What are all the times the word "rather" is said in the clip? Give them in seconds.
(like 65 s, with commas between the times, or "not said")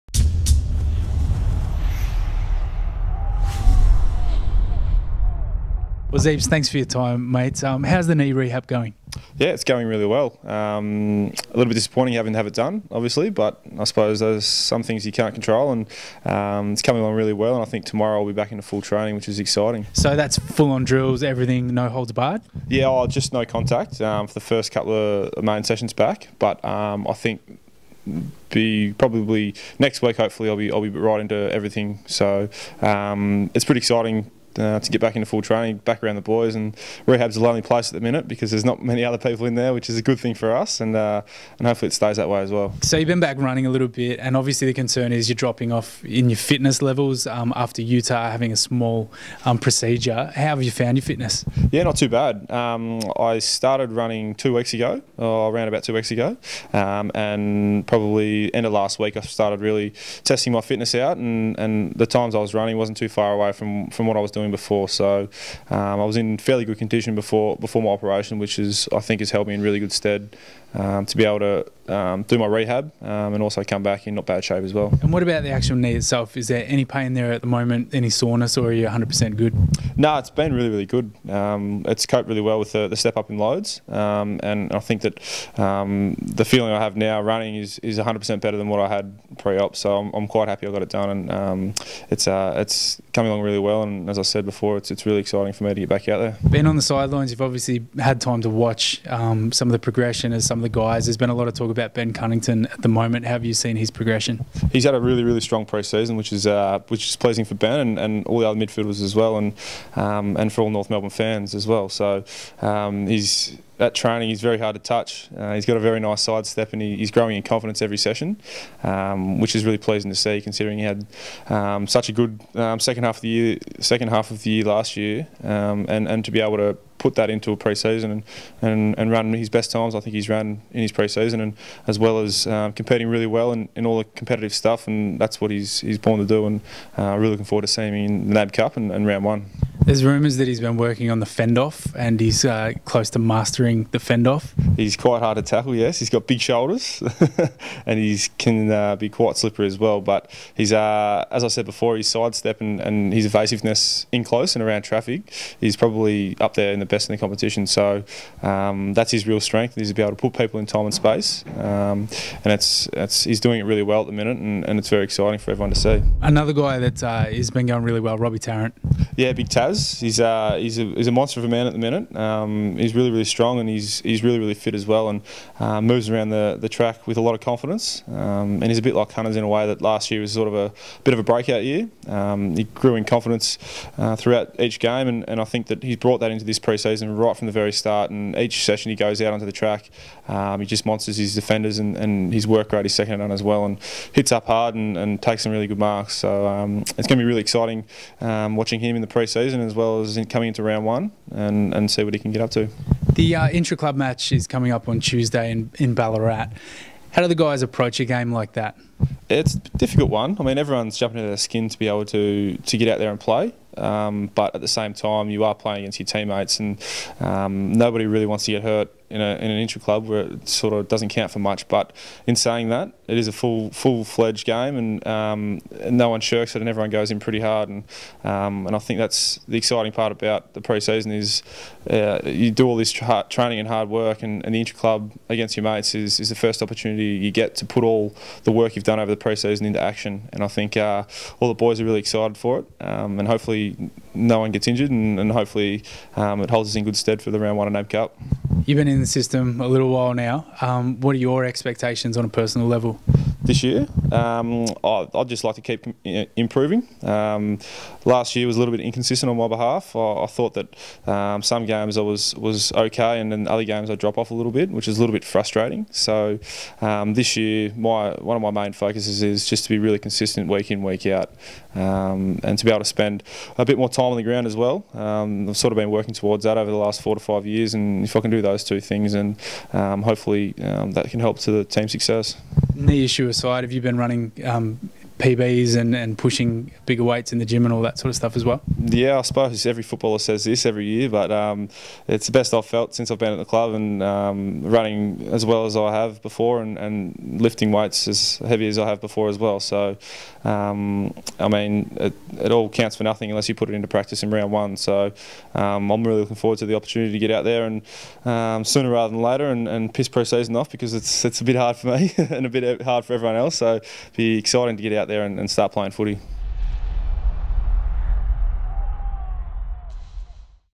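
308 s.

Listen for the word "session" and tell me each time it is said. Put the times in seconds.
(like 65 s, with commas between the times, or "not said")
25 s, 117 s, 188 s.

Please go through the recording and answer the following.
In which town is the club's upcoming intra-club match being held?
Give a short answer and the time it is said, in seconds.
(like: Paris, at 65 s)
Ballarat, at 205 s.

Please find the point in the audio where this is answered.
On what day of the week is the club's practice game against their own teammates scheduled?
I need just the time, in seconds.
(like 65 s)
205 s.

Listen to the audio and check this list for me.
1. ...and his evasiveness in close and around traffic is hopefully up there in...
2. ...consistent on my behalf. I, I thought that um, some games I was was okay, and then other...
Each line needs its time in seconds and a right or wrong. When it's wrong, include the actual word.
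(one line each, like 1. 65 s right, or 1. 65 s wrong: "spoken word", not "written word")
1. 152 s wrong: "probably", not "hopefully"
2. 258 s wrong: "inconsistent", not "consistent".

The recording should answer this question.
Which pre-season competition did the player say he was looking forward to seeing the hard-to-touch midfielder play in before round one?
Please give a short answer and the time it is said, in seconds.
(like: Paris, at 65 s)
NAB Cup, at 138 s.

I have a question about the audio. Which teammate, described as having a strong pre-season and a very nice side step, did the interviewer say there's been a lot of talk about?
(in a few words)
Ben Cunnington.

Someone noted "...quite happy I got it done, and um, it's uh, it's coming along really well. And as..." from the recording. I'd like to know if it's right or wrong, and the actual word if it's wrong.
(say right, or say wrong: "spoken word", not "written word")
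right.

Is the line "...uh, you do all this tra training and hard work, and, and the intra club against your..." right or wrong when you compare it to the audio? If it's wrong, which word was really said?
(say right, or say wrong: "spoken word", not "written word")
right.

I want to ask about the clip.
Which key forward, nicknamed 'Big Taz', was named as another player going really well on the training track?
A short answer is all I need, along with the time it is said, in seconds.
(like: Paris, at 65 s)
Robbie Tarrant, at 168 s.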